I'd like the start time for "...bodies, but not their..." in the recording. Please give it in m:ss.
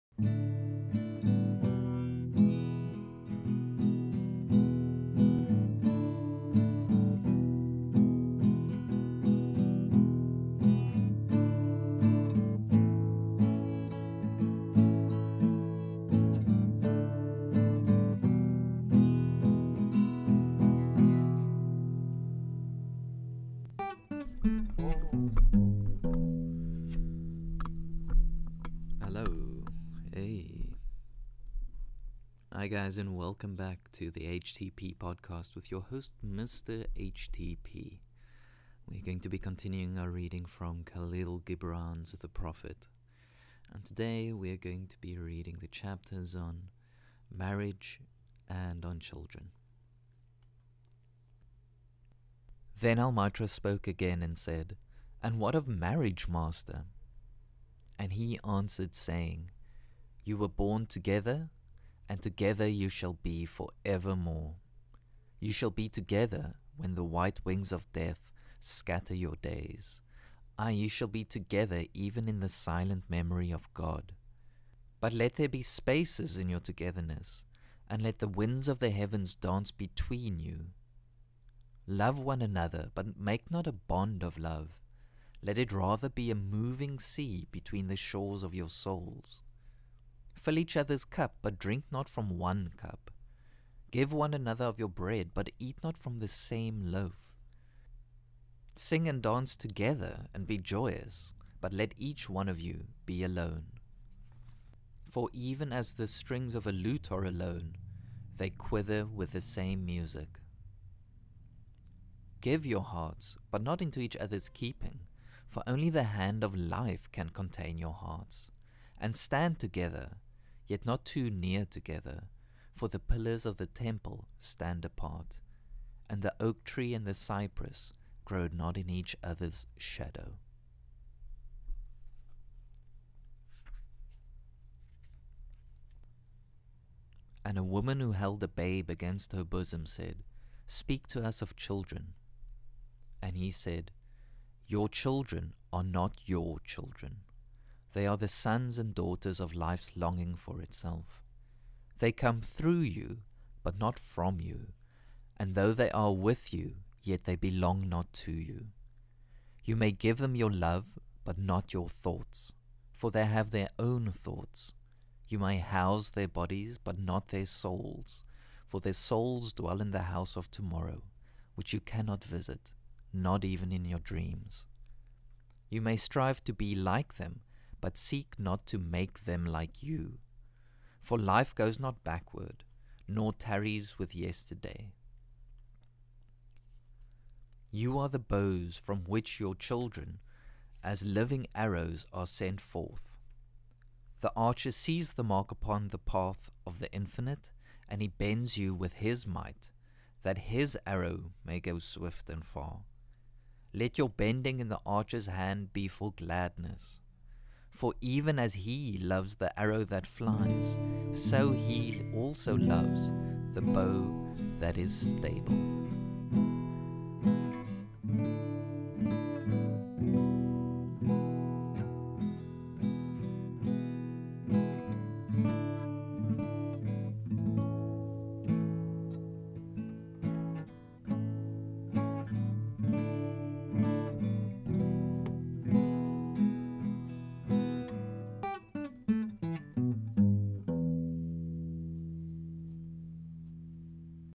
2:46.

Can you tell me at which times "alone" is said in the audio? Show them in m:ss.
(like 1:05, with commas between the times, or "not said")
1:43, 1:47.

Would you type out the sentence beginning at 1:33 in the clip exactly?
Give one another of your bread, but eat not from the same loaf.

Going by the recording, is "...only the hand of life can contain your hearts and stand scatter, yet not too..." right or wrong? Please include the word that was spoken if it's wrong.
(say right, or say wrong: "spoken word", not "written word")
wrong: "together", not "scatter".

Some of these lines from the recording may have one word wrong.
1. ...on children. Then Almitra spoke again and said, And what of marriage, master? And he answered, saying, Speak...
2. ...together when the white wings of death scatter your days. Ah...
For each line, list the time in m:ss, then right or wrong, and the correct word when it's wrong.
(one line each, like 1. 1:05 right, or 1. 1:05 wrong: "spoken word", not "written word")
1. 0:48 wrong: "You", not "Speak"
2. 1:05 right.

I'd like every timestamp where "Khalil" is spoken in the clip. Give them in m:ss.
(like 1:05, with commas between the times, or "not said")
0:40.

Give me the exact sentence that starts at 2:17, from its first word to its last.
And a woman who held a babe against her bosom said, Speak to us of children.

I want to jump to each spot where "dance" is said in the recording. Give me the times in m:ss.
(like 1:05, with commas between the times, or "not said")
1:19, 1:39.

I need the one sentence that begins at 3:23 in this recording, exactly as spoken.
Let your bending in the archer's hand be for gladness.